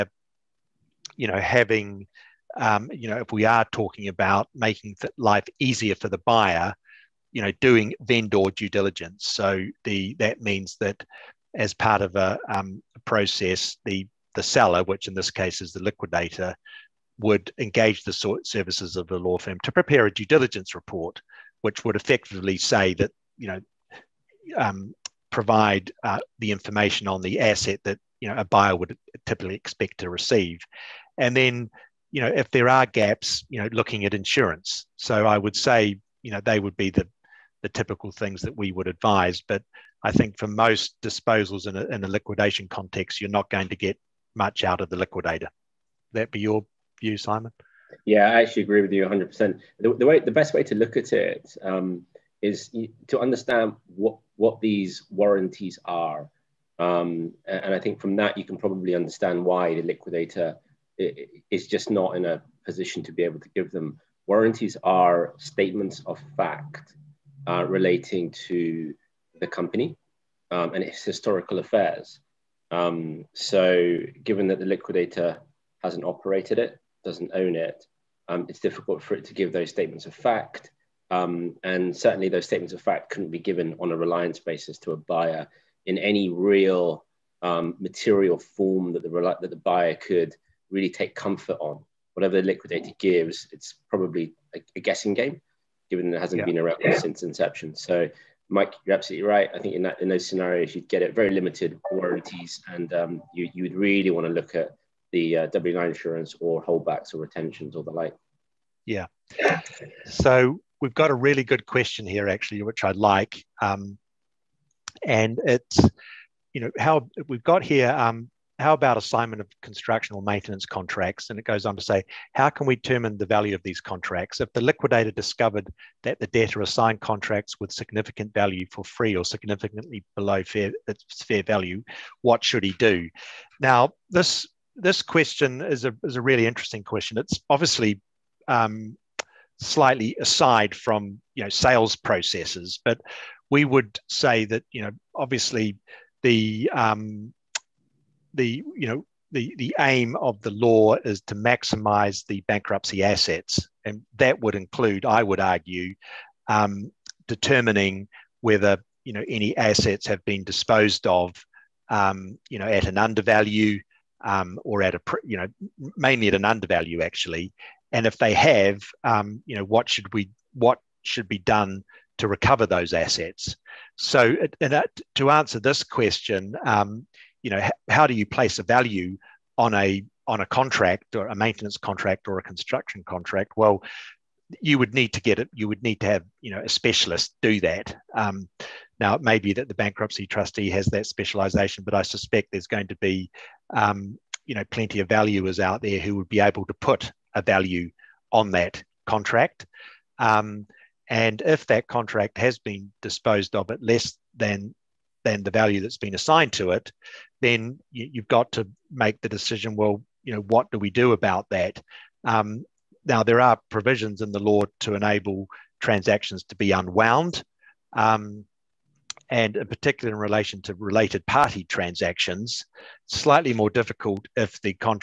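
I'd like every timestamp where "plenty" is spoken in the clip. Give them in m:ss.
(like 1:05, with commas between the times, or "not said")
3:14.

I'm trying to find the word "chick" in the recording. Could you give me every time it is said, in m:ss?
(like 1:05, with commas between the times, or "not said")
not said.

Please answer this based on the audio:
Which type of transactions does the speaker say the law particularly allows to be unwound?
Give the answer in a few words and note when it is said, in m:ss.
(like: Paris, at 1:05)
related party transactions, at 3:40.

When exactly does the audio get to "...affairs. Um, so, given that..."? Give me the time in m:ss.
1:11.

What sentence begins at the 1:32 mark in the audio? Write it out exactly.
Whatever the Liquidator gives, it's probably a, a guessing game, given it hasn't yeah.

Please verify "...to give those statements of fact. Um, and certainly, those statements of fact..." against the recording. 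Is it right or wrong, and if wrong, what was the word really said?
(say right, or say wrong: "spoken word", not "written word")
right.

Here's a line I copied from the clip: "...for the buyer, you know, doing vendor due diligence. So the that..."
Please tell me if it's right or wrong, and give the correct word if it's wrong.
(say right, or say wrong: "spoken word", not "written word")
right.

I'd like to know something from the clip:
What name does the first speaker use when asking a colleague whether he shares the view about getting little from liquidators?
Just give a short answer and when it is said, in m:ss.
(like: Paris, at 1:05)
Simon, at 0:47.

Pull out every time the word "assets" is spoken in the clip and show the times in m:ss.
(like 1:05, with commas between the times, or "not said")
0:27, 2:33, 2:39, 2:52.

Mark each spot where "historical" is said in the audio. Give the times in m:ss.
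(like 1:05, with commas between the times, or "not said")
1:11.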